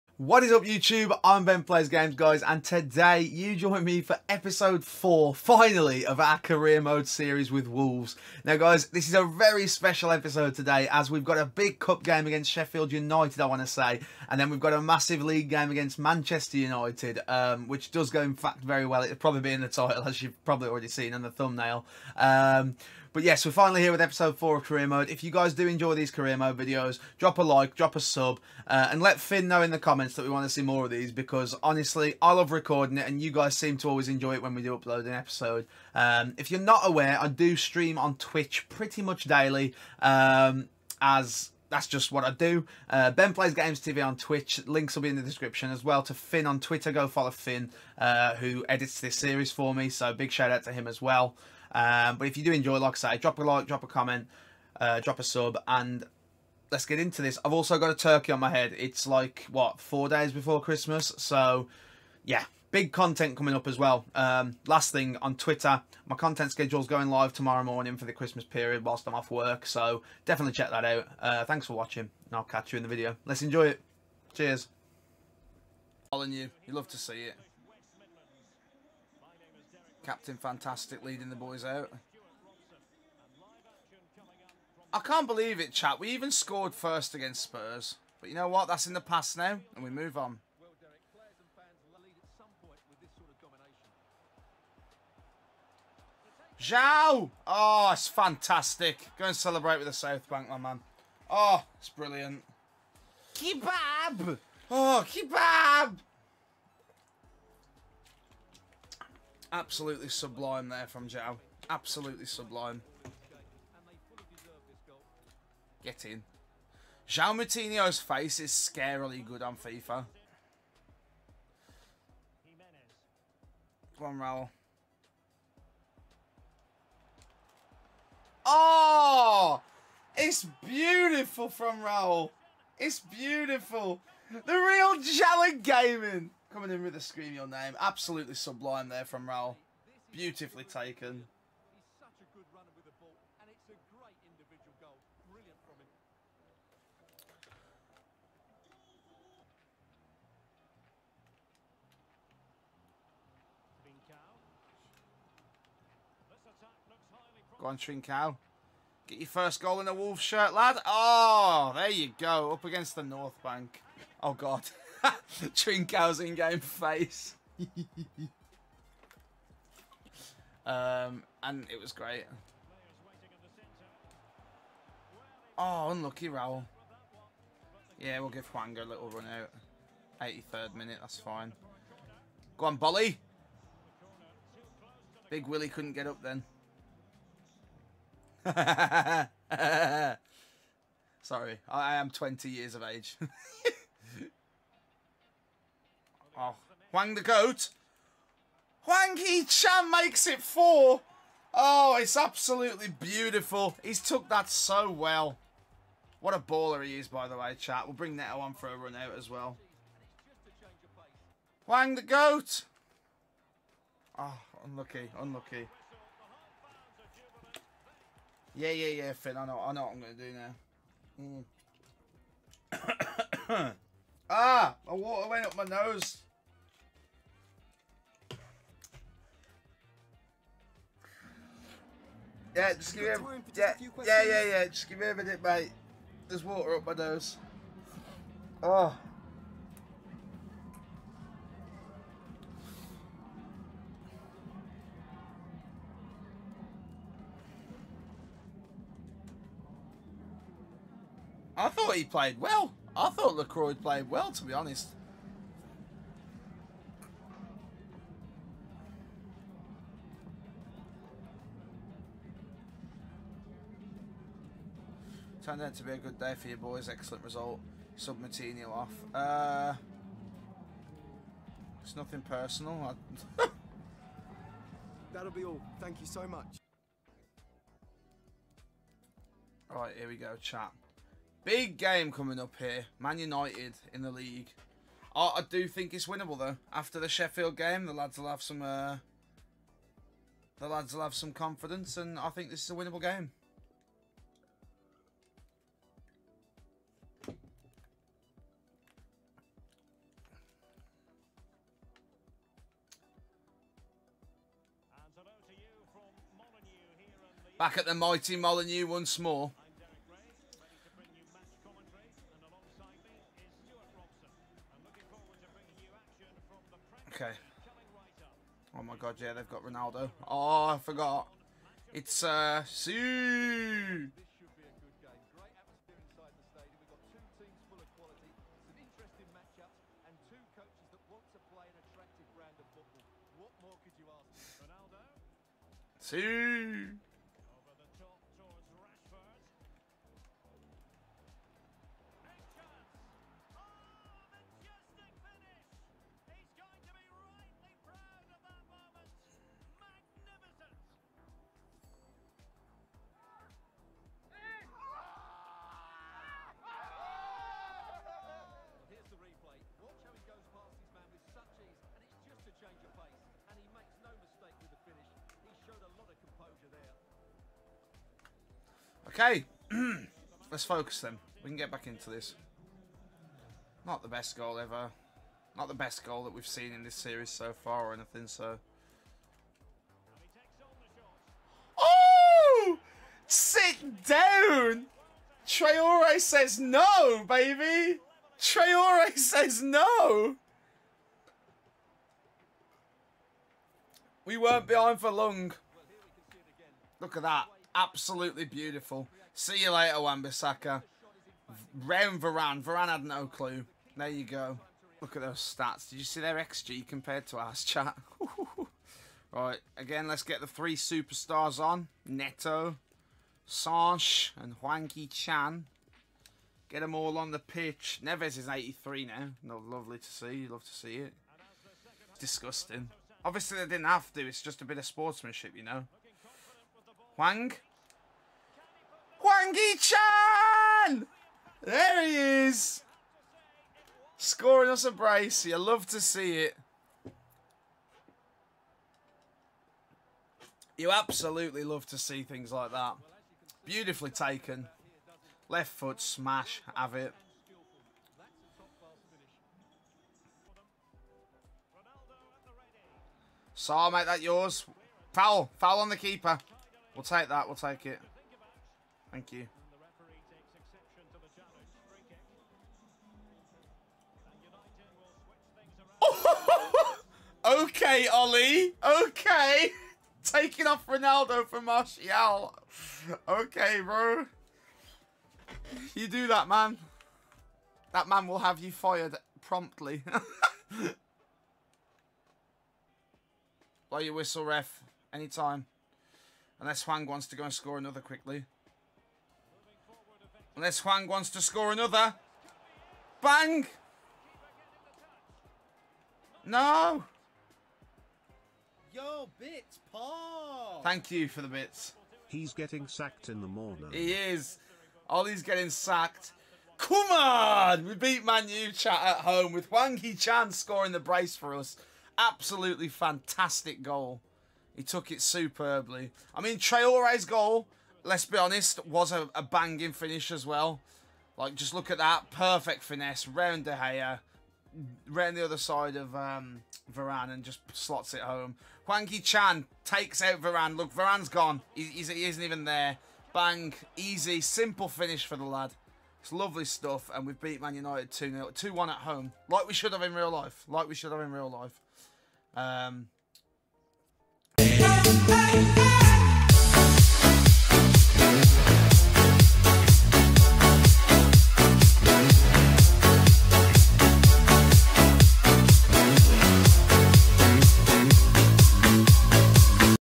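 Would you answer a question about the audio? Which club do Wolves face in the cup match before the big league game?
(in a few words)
Sheffield United.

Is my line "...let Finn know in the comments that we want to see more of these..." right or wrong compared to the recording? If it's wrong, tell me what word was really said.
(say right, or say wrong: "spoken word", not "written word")
right.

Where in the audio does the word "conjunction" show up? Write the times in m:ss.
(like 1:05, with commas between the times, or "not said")
not said.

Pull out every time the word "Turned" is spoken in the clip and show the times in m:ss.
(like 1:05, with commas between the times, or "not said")
4:25.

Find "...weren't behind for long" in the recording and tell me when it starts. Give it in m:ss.
6:34.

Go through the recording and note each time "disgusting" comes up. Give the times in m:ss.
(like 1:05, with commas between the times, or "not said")
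7:02.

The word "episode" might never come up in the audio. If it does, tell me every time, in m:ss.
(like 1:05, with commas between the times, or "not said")
0:04, 0:10, 0:23, 0:35.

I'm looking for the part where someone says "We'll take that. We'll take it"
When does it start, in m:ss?
7:36.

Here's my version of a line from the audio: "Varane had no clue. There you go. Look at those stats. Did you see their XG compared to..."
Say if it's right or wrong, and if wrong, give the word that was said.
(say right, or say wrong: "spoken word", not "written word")
right.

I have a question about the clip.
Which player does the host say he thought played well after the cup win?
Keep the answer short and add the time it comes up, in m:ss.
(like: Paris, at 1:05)
LaCroix, at 4:13.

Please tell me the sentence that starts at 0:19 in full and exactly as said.
It'll probably be in the title as you've probably already seen in the thumbnail.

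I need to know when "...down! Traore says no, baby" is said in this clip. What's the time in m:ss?
6:24.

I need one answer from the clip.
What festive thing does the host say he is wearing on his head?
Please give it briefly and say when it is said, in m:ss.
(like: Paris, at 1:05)
A turkey, at 0:57.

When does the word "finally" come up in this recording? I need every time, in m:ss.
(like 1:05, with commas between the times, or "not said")
0:05, 0:23.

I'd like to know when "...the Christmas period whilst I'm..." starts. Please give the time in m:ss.
1:08.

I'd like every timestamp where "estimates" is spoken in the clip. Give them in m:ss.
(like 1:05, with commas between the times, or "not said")
not said.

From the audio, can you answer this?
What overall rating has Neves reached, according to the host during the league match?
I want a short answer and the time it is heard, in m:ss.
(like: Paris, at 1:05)
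83, at 6:58.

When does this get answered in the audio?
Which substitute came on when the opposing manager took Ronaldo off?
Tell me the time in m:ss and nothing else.
7:51.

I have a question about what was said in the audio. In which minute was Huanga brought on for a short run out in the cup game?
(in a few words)
83rd minute.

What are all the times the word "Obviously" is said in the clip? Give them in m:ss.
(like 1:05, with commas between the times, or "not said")
7:03.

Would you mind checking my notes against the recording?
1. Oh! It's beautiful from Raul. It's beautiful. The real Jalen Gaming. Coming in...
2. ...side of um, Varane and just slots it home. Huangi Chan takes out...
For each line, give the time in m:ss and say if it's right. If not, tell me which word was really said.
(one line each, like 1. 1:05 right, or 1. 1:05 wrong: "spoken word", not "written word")
1. 2:08 right
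2. 8:45 right.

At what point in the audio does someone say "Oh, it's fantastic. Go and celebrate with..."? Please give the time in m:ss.
1:37.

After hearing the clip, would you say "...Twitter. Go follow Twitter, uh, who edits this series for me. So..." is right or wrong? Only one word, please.
wrong.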